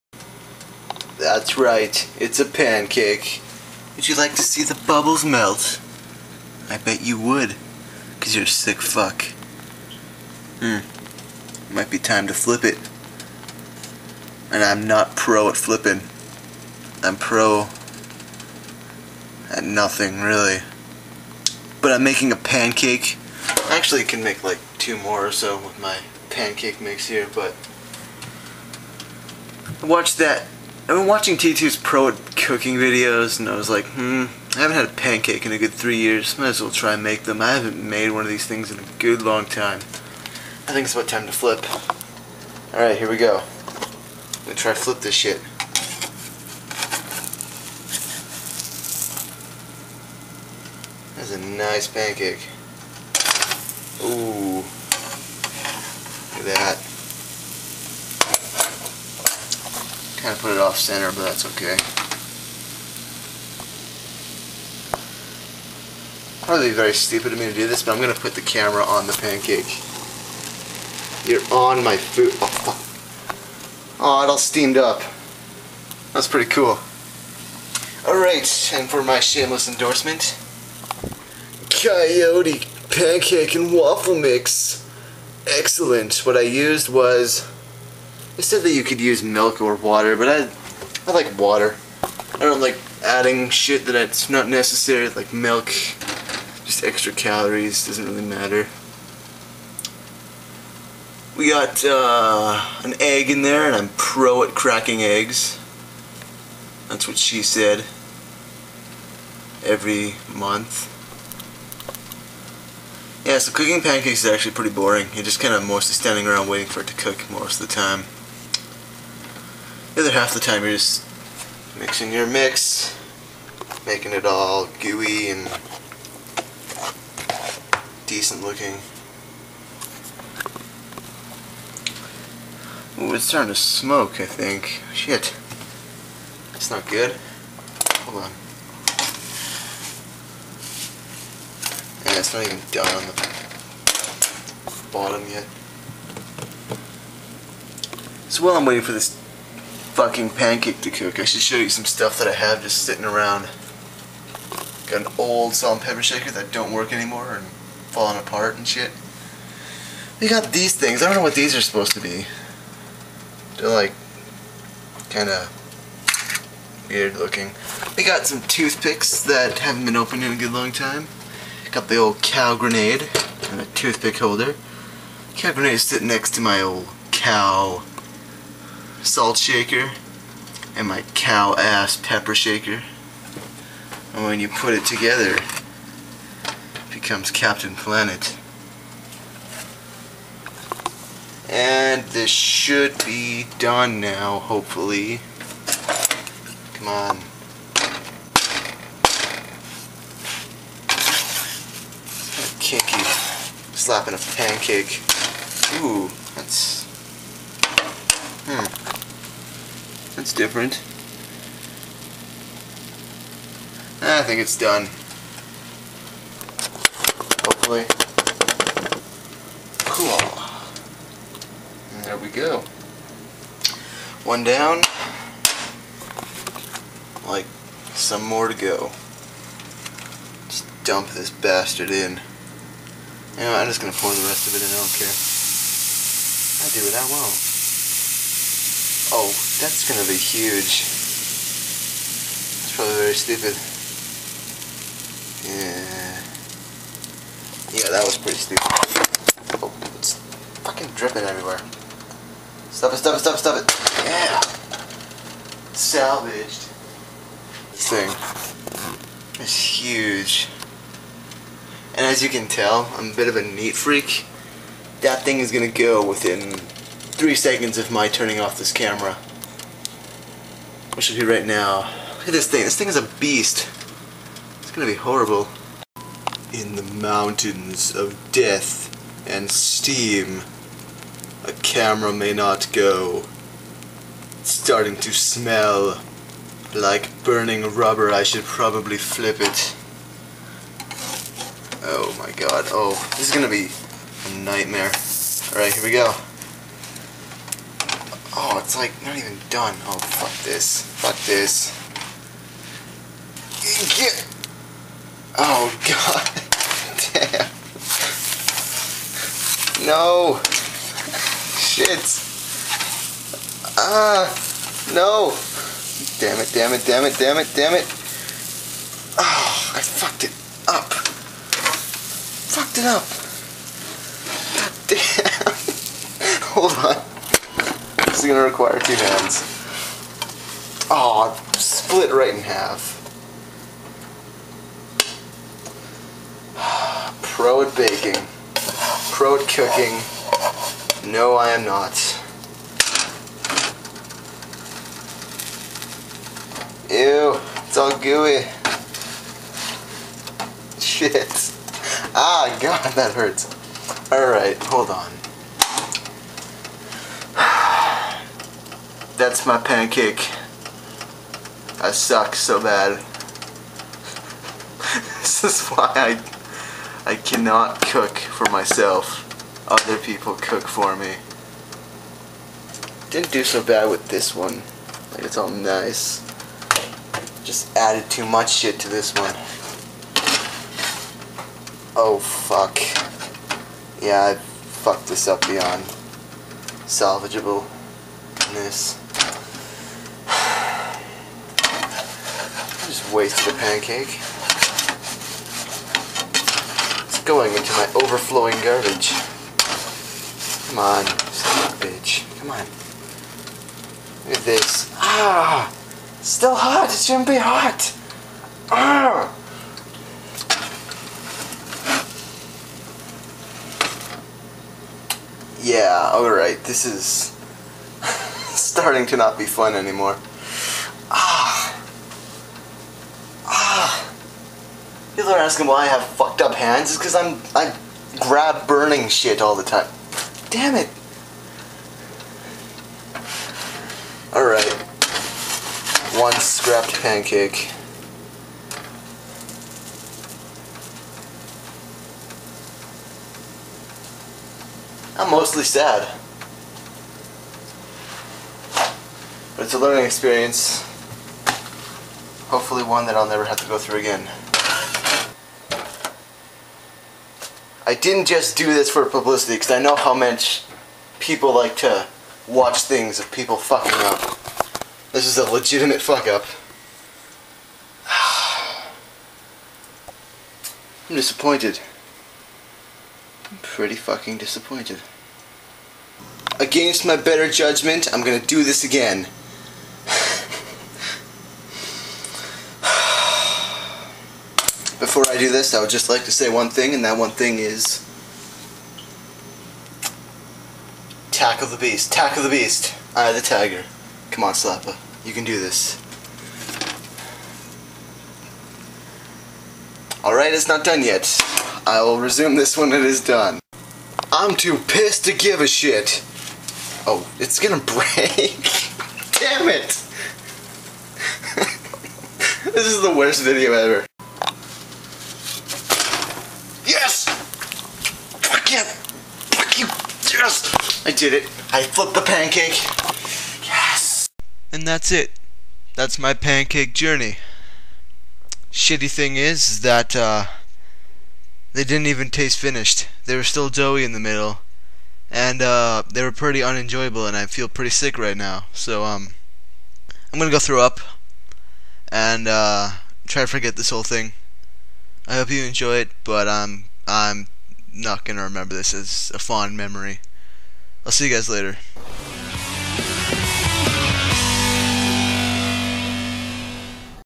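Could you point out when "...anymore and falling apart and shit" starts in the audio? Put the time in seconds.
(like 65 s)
156 s.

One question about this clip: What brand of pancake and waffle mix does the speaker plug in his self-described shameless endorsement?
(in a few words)
Coyote.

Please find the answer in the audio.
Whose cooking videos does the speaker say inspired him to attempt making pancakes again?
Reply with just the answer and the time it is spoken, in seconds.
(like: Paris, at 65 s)
T2, at 31 s.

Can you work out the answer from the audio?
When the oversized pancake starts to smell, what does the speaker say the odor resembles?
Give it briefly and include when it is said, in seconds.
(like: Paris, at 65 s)
Burning rubber, at 287 s.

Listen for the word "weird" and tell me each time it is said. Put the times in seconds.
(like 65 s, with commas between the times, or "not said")
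166 s.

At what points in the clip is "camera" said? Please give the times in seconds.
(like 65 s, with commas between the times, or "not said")
68 s, 268 s, 281 s.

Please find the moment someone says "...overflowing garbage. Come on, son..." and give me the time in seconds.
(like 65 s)
397 s.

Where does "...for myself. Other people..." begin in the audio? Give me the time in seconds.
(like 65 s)
368 s.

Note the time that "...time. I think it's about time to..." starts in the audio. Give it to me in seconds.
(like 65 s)
39 s.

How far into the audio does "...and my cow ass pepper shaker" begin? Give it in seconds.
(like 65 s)
180 s.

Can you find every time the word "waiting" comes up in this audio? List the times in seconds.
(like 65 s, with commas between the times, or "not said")
116 s, 148 s.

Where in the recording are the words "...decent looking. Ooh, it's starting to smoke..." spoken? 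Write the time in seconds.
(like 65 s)
128 s.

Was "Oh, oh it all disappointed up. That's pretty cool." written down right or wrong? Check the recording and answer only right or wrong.
wrong.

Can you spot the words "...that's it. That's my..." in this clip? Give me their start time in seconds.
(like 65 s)
524 s.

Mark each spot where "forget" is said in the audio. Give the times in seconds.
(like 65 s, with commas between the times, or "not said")
543 s.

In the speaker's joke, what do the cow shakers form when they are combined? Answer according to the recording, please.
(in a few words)
Captain Planet.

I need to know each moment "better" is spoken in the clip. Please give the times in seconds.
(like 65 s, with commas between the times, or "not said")
477 s.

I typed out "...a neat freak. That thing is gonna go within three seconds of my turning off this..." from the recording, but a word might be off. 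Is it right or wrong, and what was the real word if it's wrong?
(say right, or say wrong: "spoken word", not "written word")
right.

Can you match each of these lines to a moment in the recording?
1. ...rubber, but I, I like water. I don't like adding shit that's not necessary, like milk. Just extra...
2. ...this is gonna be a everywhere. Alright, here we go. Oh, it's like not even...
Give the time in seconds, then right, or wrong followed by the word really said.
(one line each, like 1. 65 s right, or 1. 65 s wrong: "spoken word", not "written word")
1. 89 s wrong: "water", not "rubber"
2. 293 s wrong: "nightmare", not "everywhere".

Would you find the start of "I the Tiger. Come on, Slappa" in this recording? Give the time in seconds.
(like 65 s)
493 s.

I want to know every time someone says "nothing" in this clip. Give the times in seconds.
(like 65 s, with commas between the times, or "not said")
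19 s.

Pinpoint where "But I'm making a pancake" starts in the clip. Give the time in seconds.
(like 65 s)
21 s.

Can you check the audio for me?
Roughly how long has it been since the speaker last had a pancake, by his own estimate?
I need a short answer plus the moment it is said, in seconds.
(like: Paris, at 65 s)
3 years, at 35 s.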